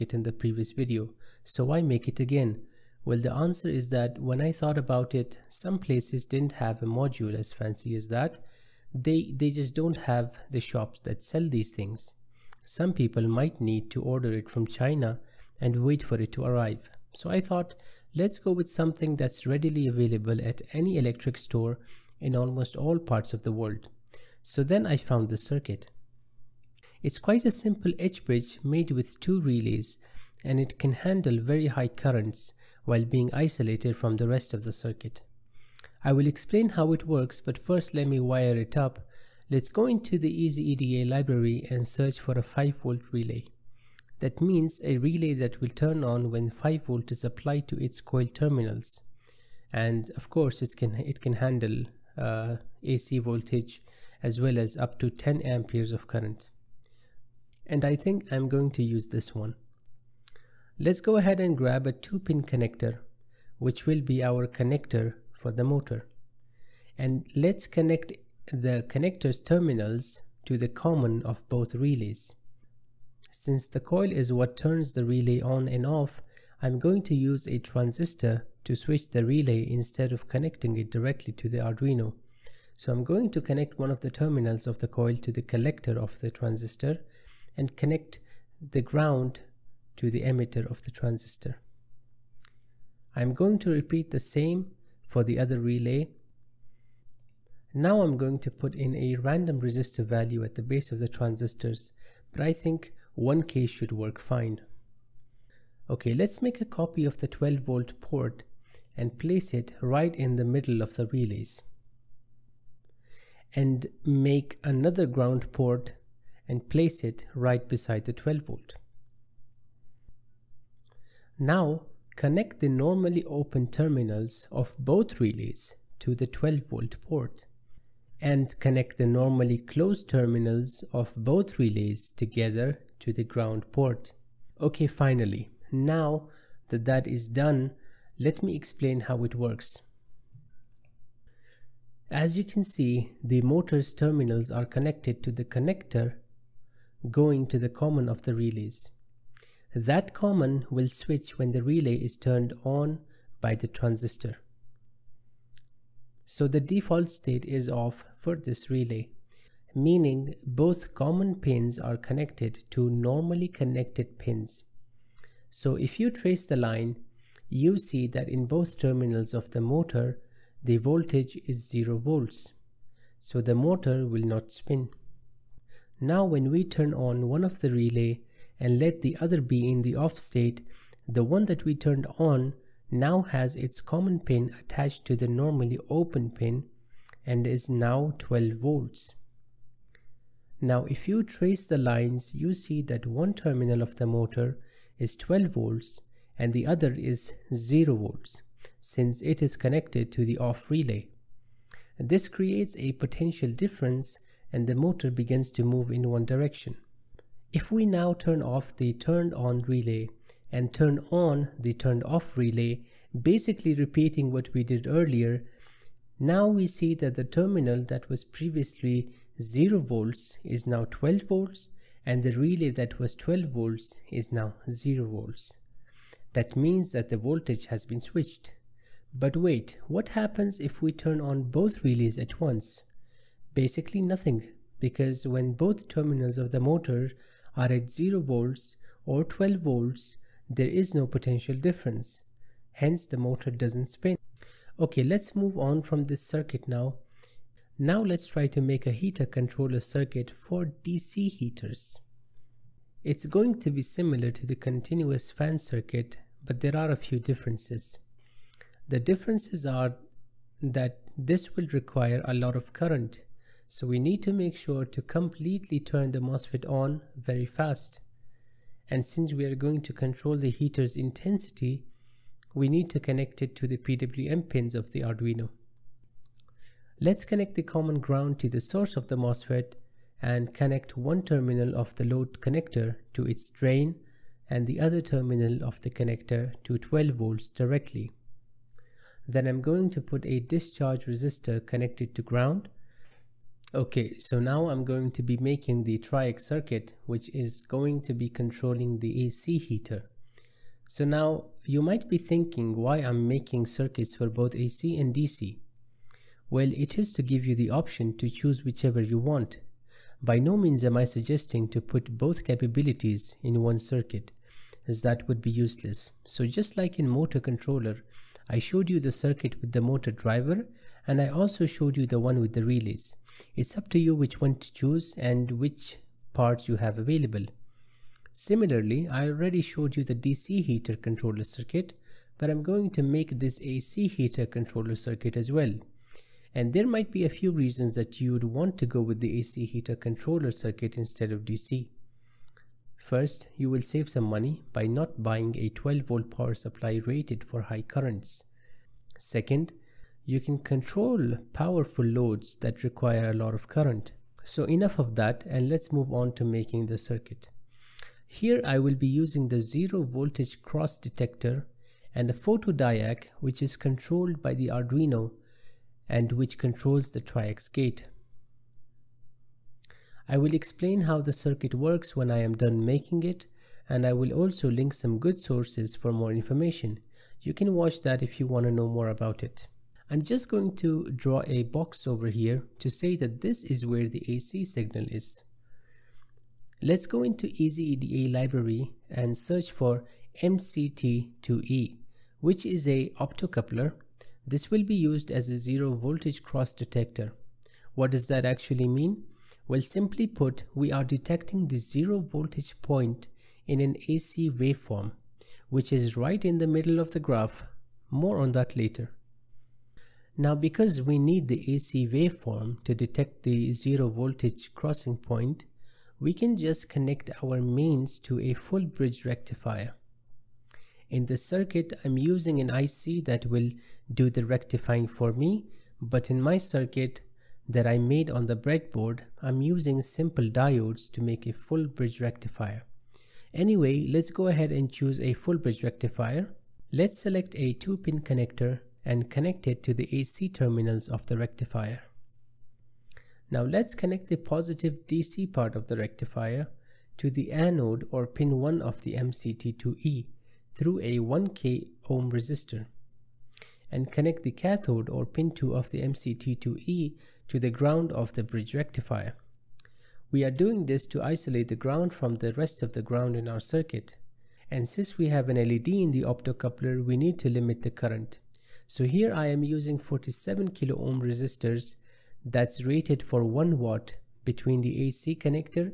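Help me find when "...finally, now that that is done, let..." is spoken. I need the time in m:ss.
2:14.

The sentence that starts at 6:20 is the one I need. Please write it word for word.
I'm just going to draw a box over here to say that this is where the AC signal is.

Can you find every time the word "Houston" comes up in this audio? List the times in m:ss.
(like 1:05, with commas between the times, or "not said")
not said.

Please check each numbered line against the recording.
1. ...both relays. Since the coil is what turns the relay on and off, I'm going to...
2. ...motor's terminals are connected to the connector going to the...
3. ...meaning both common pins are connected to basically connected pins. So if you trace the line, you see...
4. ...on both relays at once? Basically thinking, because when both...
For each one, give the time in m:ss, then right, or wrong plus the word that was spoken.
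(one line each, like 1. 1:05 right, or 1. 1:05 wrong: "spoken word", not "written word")
1. 1:11 right
2. 2:23 right
3. 2:39 wrong: "normally", not "basically"
4. 3:51 wrong: "nothing", not "thinking".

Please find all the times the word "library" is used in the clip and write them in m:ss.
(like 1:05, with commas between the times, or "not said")
0:41, 6:28.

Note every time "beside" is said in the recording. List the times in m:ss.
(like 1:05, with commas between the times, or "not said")
1:57.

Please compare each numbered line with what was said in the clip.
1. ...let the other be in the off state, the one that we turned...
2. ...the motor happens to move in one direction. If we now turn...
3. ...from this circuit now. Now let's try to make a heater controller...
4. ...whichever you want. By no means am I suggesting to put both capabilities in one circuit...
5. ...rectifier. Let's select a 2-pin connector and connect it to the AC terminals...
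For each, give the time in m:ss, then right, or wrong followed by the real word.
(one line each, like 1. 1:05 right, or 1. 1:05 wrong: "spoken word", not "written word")
1. 2:58 right
2. 3:24 wrong: "begins", not "happens"
3. 4:05 right
4. 5:08 right
5. 7:15 right.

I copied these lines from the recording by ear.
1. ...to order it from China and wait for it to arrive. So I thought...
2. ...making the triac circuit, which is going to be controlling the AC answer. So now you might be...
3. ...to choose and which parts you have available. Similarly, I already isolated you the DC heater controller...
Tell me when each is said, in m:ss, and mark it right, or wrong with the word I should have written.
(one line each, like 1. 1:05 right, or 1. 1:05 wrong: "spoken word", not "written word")
1. 0:13 right
2. 4:55 wrong: "heater", not "answer"
3. 5:24 wrong: "showed", not "isolated".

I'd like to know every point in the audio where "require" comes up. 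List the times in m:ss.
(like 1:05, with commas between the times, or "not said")
4:21, 5:52.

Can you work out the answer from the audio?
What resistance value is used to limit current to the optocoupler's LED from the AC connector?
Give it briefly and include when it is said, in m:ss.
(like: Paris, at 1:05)
47 kilo ohm, at 7:49.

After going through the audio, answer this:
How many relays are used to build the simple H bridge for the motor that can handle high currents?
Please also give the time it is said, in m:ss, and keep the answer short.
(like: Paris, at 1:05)
2, at 0:29.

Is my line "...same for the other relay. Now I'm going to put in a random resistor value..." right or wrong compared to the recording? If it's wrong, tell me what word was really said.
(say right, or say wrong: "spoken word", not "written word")
right.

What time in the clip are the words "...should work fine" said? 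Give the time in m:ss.
1:43.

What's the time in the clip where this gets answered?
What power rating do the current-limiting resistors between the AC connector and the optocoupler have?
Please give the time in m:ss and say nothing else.
7:53.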